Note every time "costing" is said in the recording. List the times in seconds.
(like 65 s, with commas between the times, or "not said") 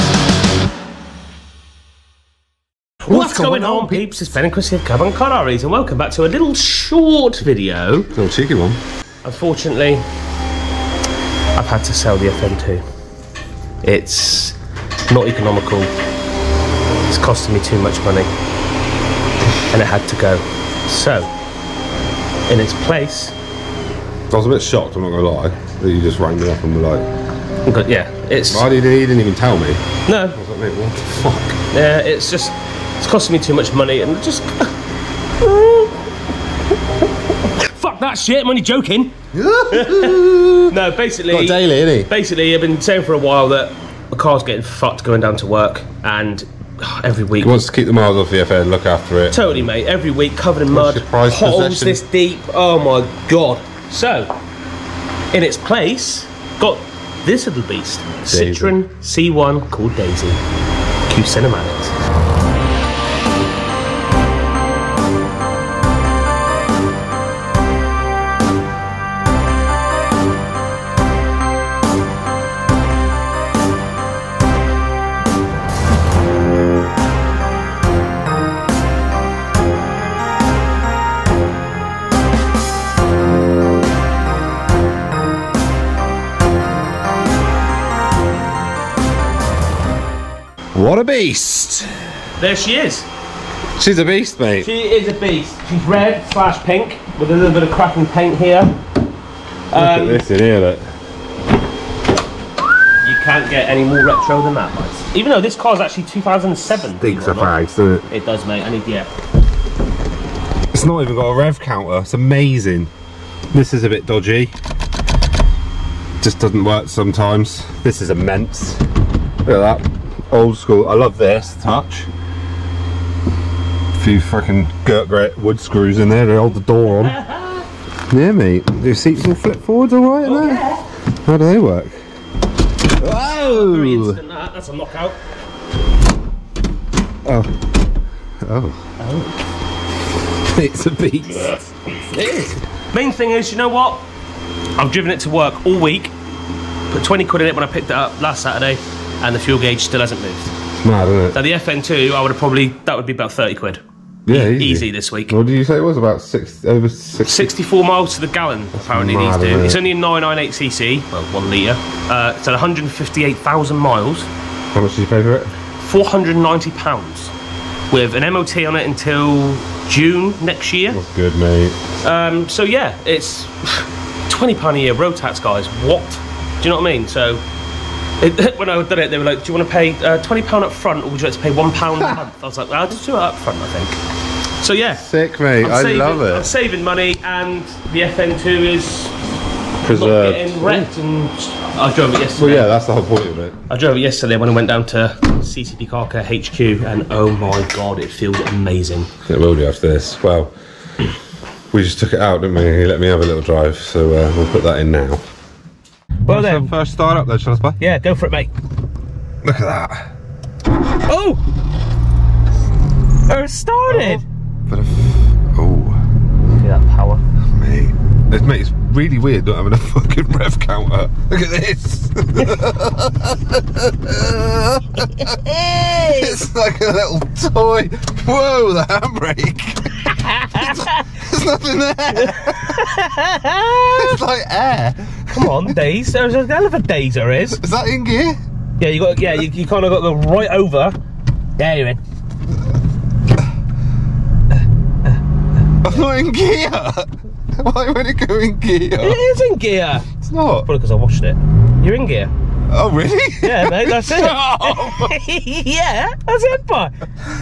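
17 s, 33 s.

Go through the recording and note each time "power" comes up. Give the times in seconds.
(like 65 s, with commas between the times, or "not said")
216 s.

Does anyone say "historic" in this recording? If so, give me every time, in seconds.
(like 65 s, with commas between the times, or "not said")
not said.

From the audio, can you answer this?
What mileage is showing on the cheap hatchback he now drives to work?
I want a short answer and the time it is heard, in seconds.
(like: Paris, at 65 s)
158,000 miles, at 162 s.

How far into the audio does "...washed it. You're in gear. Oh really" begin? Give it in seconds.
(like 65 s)
250 s.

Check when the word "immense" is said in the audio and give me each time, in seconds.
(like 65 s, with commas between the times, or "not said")
118 s.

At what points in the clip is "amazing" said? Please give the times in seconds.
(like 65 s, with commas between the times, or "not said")
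112 s, 198 s.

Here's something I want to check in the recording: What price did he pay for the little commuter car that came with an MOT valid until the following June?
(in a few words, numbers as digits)
£490.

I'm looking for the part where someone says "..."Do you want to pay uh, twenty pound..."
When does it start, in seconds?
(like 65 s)
179 s.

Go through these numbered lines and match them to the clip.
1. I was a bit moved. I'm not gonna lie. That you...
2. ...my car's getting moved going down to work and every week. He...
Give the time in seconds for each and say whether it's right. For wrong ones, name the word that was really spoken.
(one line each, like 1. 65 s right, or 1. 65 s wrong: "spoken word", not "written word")
1. 23 s wrong: "shocked", not "moved"
2. 44 s wrong: "fucked", not "moved".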